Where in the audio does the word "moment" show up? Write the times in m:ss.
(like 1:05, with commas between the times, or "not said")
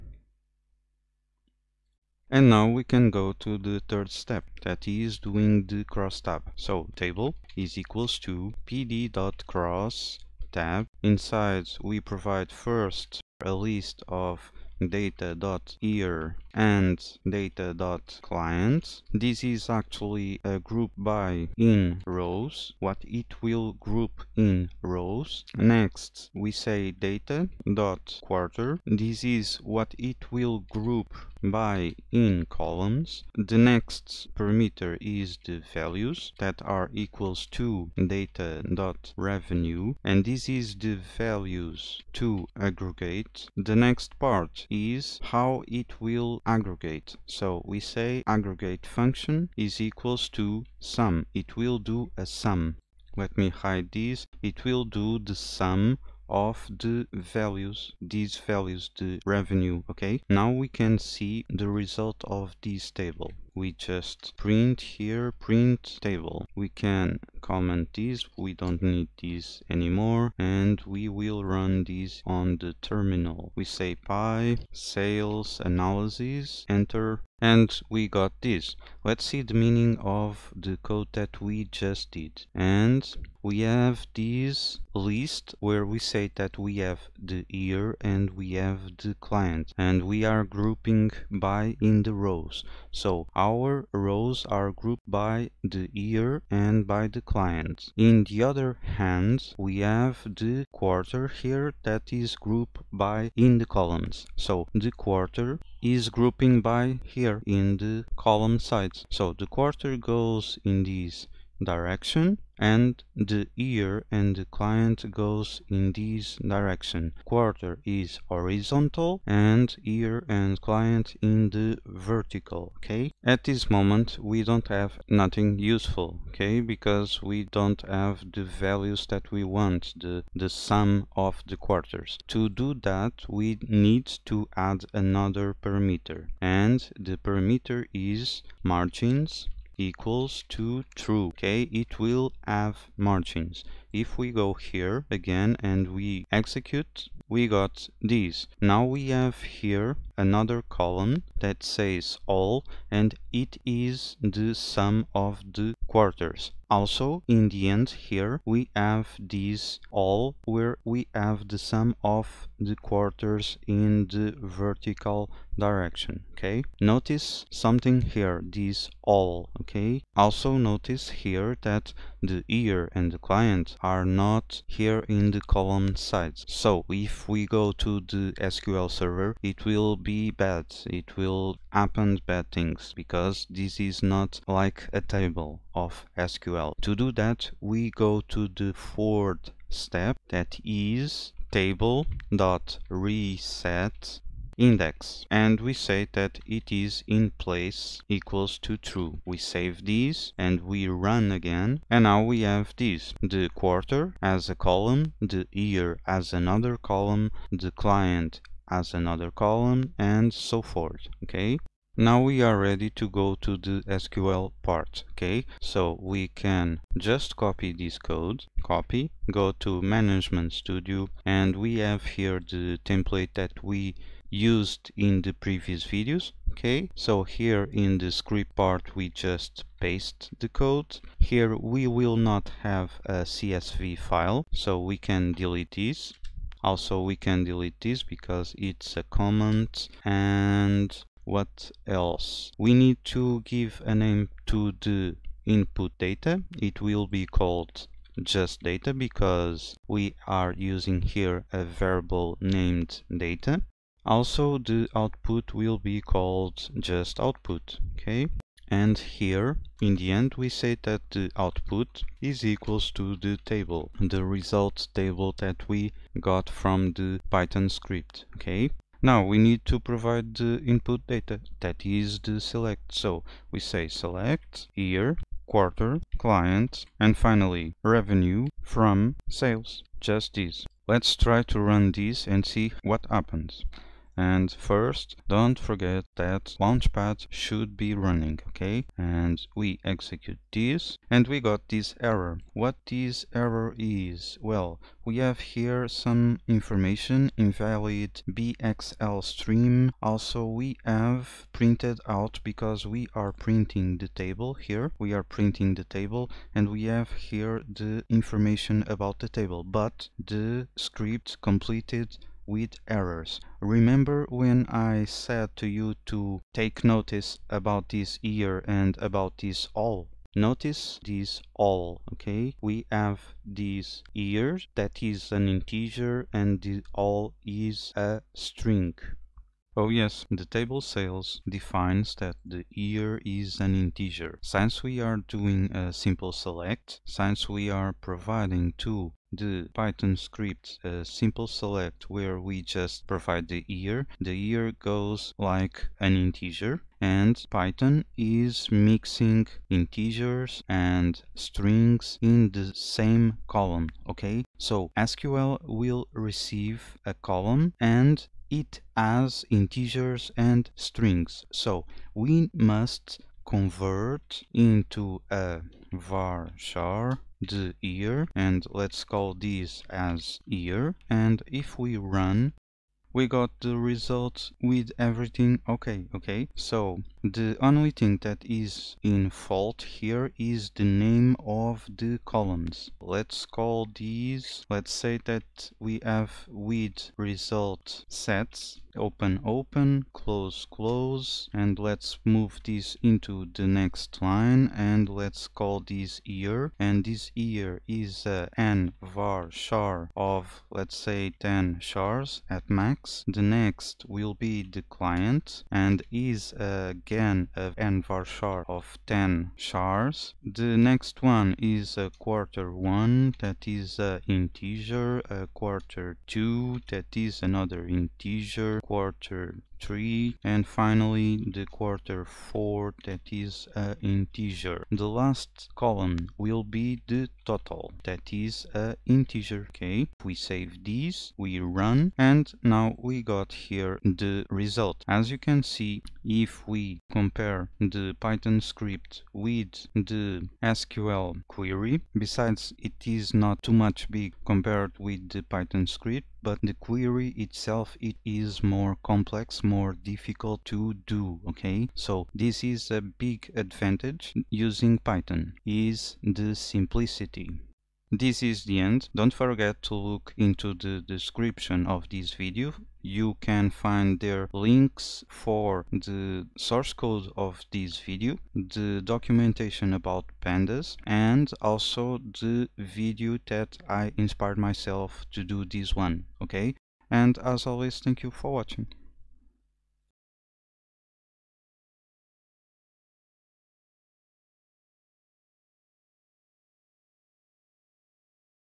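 2:03.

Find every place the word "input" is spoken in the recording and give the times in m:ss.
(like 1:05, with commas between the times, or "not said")
4:05, 4:30.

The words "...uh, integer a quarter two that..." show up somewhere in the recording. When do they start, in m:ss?
6:54.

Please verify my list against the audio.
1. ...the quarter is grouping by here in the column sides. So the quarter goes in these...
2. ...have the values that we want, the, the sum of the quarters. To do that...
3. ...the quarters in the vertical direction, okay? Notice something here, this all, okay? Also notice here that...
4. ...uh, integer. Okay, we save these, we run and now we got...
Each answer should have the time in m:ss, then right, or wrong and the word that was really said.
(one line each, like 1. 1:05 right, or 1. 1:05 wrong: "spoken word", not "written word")
1. 1:44 right
2. 2:07 right
3. 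2:42 right
4. 7:08 right.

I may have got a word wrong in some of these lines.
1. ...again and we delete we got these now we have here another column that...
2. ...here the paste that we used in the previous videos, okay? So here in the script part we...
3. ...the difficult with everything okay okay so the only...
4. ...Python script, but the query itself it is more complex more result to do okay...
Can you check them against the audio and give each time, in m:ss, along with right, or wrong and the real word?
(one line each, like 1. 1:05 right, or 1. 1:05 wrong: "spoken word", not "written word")
1. 2:25 wrong: "execute", not "delete"
2. 3:42 wrong: "template", not "paste"
3. 6:13 wrong: "result", not "difficult"
4. 7:25 wrong: "difficult", not "result".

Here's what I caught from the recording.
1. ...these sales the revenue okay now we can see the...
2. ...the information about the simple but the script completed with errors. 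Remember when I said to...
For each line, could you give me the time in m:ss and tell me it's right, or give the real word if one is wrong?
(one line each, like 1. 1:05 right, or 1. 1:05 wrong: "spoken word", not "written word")
1. 0:58 wrong: "values", not "sales"
2. 5:07 wrong: "table", not "simple".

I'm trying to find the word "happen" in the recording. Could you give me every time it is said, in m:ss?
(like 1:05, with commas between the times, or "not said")
3:01, 4:43.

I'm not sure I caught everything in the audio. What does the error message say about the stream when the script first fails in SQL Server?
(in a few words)
invalid BXL stream.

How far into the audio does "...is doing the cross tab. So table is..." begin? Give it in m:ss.
0:04.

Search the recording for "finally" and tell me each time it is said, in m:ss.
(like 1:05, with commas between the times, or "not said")
4:37, 7:00.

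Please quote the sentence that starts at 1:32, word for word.
So our rows are grouped by the year and by the client.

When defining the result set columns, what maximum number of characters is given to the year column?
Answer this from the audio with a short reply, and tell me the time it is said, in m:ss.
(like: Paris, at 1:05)
10, at 6:40.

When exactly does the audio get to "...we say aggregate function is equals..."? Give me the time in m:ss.
0:47.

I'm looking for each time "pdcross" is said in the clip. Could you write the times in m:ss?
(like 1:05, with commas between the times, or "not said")
0:08.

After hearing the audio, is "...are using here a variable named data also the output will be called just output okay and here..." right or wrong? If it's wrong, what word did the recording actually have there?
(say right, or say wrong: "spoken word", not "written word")
right.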